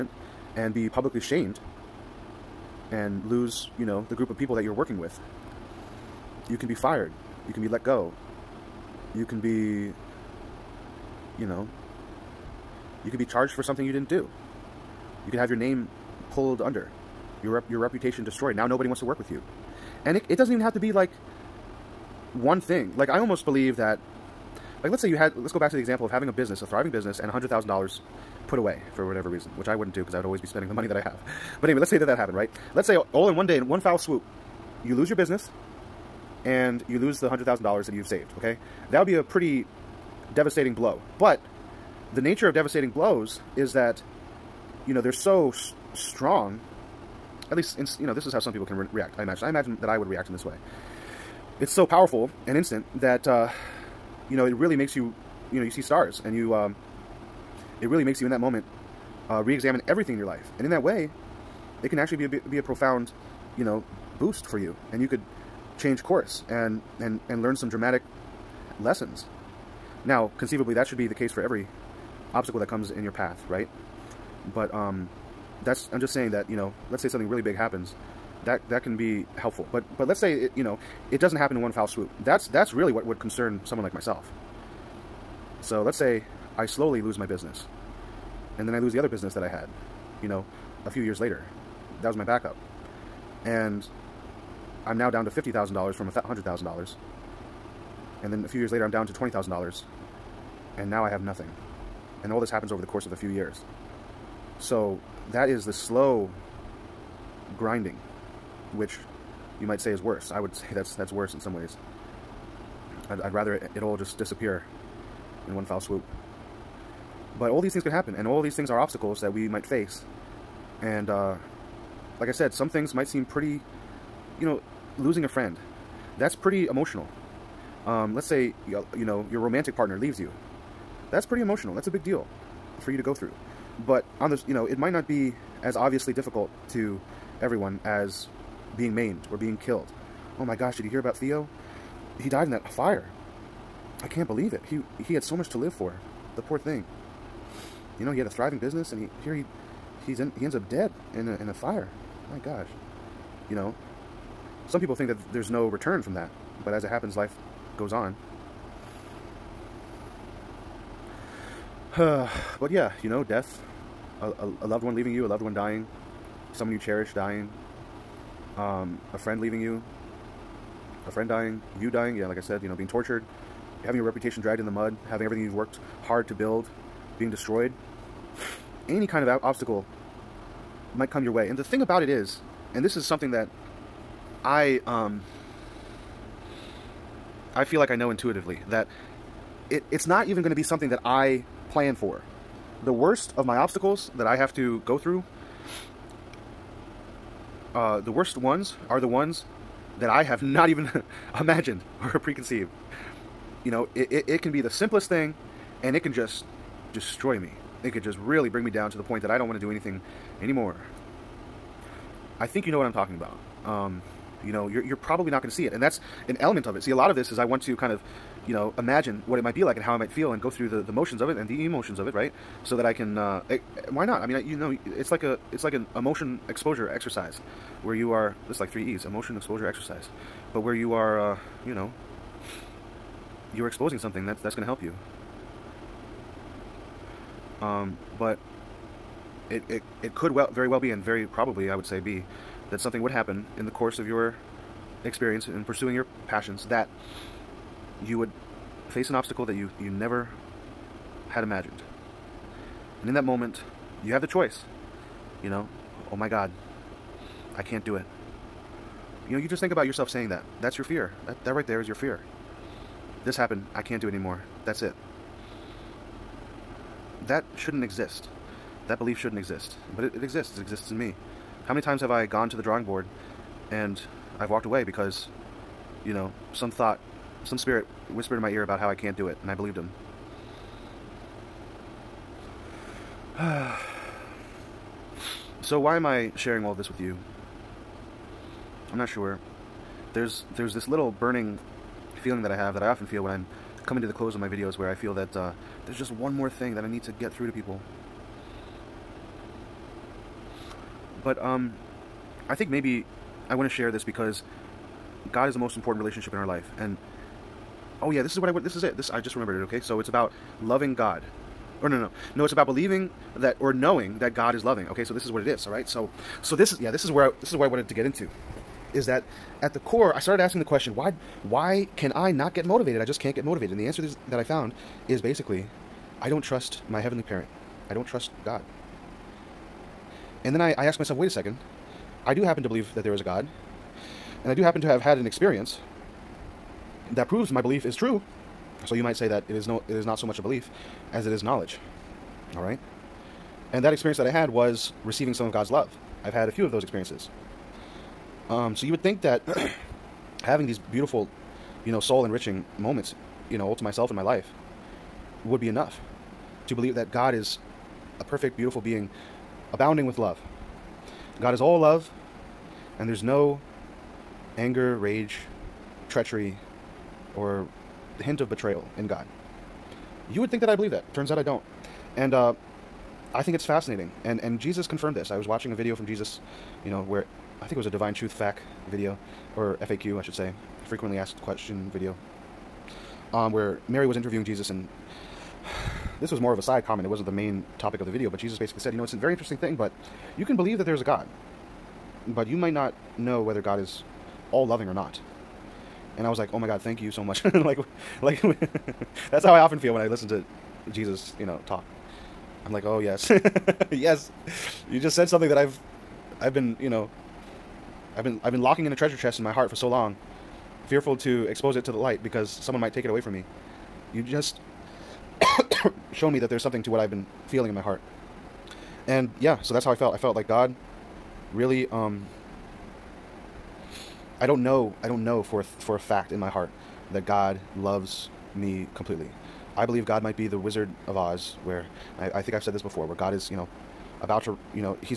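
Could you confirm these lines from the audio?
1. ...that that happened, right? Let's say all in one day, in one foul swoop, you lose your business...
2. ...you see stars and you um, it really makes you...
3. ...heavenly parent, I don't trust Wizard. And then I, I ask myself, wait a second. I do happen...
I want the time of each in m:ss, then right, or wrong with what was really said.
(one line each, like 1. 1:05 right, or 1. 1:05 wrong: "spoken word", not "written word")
1. 0:31 right
2. 0:55 right
3. 5:27 wrong: "God", not "Wizard".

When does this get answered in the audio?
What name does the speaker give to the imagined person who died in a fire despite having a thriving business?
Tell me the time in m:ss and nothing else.
2:21.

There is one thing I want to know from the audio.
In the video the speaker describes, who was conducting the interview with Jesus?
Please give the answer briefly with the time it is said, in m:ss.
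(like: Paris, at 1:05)
Mary, at 6:23.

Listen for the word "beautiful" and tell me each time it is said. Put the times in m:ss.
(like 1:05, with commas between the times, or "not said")
5:50, 5:58.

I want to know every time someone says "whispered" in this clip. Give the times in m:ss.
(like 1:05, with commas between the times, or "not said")
4:38.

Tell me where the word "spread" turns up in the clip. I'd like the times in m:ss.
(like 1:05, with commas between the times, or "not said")
not said.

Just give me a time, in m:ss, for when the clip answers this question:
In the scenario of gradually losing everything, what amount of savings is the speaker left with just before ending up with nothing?
1:39.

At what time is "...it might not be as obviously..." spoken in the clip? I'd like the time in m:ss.
2:14.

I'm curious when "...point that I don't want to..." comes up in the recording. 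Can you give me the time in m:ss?
3:29.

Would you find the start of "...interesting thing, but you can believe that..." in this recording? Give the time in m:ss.
6:29.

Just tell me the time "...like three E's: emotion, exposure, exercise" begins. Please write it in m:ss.
3:48.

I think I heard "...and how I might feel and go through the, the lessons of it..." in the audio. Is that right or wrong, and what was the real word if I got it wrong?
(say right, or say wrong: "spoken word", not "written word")
wrong: "motions", not "lessons".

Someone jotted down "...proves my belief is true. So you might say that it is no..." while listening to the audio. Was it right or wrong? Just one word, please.
right.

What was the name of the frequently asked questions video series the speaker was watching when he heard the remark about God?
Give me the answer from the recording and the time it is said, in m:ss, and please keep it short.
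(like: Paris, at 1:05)
Divine Truth FAQ, at 6:17.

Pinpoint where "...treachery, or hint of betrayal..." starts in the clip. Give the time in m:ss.
6:06.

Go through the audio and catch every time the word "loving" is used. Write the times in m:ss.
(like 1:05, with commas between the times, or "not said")
5:10, 5:14, 6:34.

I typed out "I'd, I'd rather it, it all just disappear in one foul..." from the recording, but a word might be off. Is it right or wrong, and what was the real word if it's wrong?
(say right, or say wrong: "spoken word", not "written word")
right.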